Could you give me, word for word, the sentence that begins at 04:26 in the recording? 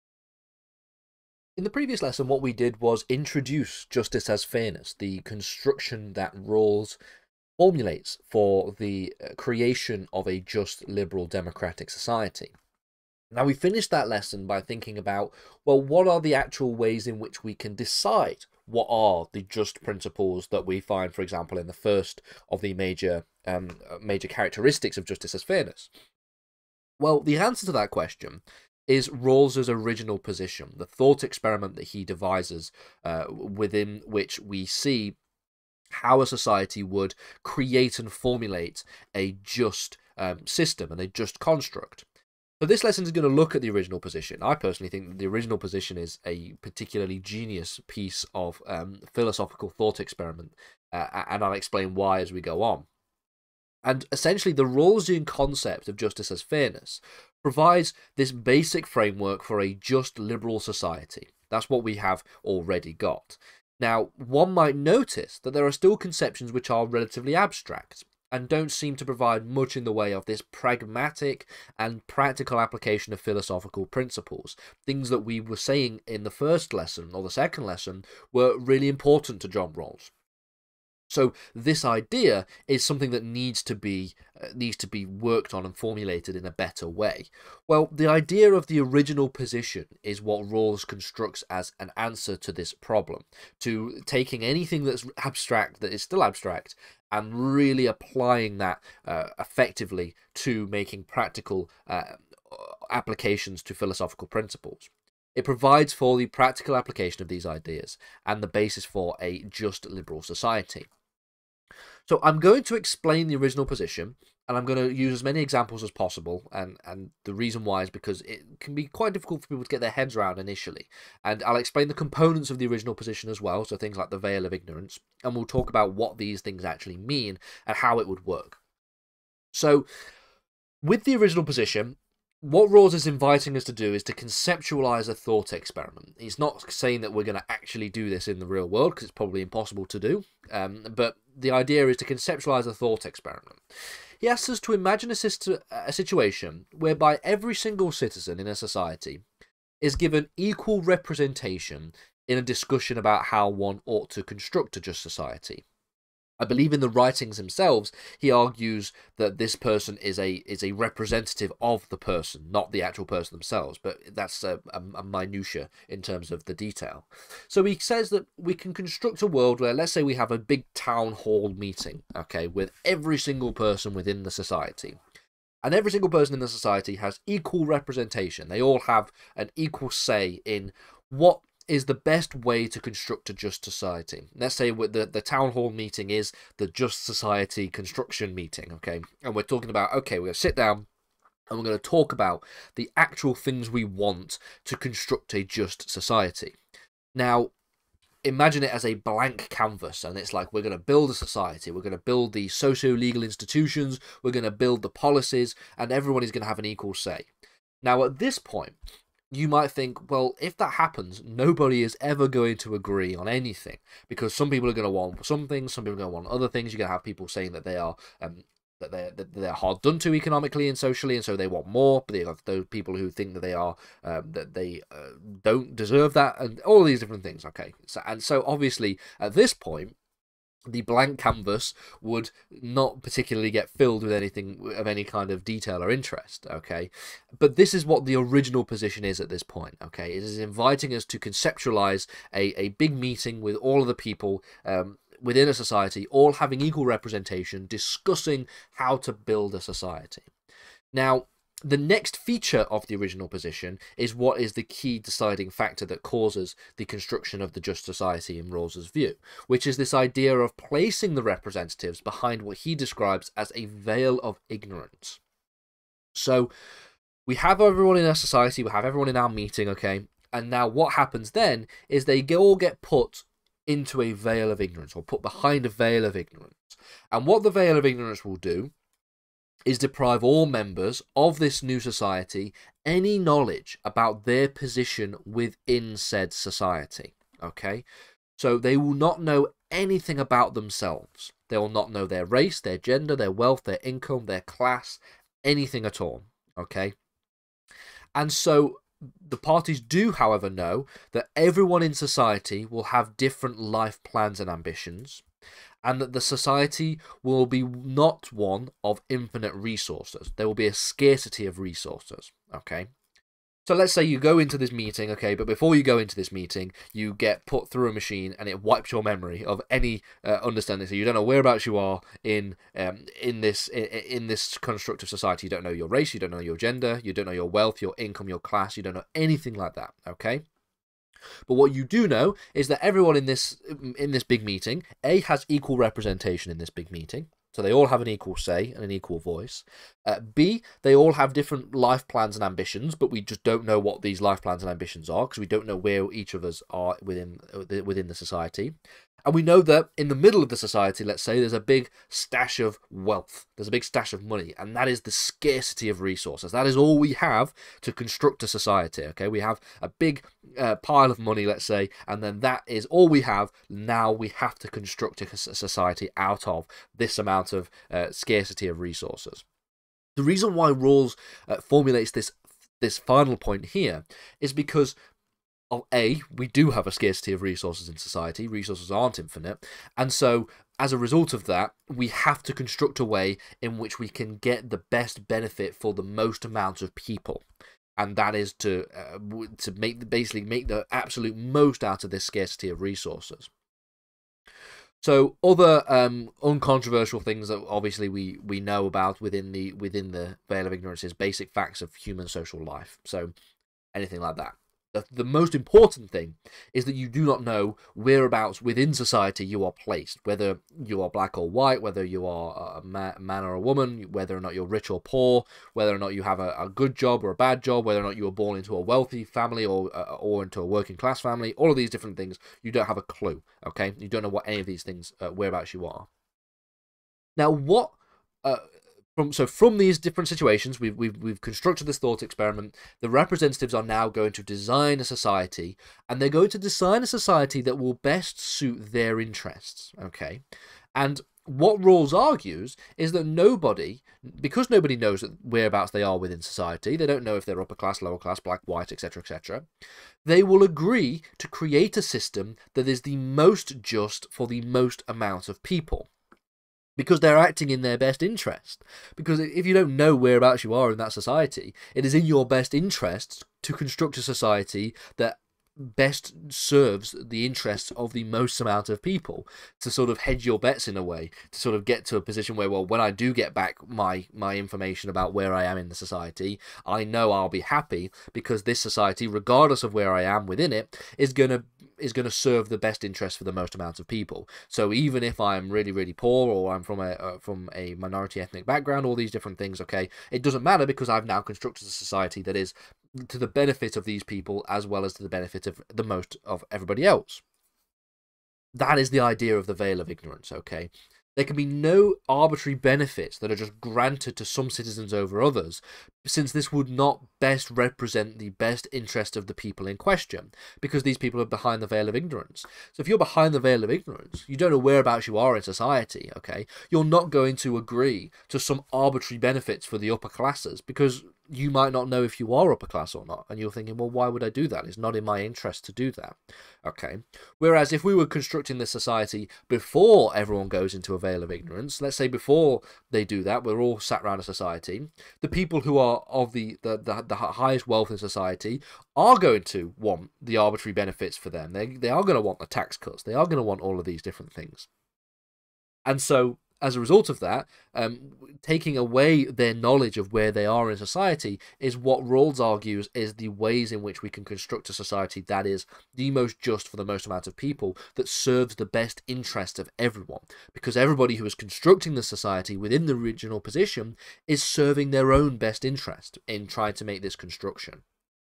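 So we have everyone in our society, we have everyone in our meeting, okay?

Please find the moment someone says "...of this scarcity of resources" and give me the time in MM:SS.
06:32.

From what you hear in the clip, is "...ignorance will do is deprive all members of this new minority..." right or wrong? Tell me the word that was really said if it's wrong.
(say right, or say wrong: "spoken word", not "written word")
wrong: "society", not "minority".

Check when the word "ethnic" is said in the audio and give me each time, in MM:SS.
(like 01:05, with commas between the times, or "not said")
08:08.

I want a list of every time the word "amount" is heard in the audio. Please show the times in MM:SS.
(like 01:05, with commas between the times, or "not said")
06:07, 06:26, 07:35, 07:48, 08:03, 09:17.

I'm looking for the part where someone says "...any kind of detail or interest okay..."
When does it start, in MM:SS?
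03:54.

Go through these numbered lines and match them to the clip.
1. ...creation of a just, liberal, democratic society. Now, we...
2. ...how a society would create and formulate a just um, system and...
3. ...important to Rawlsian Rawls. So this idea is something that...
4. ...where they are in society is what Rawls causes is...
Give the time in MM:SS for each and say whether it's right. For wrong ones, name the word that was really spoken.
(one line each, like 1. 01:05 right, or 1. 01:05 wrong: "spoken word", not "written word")
1. 00:09 right
2. 00:35 right
3. 01:18 wrong: "John", not "Rawlsian"
4. 09:10 wrong: "argues", not "causes".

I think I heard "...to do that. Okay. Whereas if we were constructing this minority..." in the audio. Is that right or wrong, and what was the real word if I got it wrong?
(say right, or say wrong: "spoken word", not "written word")
wrong: "society", not "minority".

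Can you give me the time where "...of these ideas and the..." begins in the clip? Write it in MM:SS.
01:47.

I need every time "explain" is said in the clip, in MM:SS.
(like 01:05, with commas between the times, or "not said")
00:51, 01:52, 02:01.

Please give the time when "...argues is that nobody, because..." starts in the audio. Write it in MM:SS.
07:22.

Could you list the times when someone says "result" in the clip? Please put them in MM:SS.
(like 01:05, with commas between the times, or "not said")
06:20, 09:06.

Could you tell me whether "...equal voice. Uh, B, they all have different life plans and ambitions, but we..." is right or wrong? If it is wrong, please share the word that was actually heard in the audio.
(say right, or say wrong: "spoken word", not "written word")
right.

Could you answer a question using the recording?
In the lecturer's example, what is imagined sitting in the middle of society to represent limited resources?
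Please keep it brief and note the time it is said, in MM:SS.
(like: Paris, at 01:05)
a big stash of wealth, at 05:51.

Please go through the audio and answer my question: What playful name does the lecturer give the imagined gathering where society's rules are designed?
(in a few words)
just society construction meeting.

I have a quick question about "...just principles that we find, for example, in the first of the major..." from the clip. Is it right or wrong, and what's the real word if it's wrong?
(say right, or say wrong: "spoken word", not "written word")
right.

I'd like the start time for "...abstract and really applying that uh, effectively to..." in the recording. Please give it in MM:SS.
01:36.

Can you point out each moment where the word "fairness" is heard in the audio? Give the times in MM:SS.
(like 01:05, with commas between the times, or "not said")
00:04, 00:25, 00:56.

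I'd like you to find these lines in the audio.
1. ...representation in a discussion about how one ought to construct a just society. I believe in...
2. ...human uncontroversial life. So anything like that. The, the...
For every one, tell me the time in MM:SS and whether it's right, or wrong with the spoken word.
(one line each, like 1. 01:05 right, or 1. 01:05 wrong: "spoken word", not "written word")
1. 02:30 right
2. 06:41 wrong: "social", not "uncontroversial".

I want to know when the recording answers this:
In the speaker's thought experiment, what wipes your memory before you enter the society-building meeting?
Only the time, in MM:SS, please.
05:17.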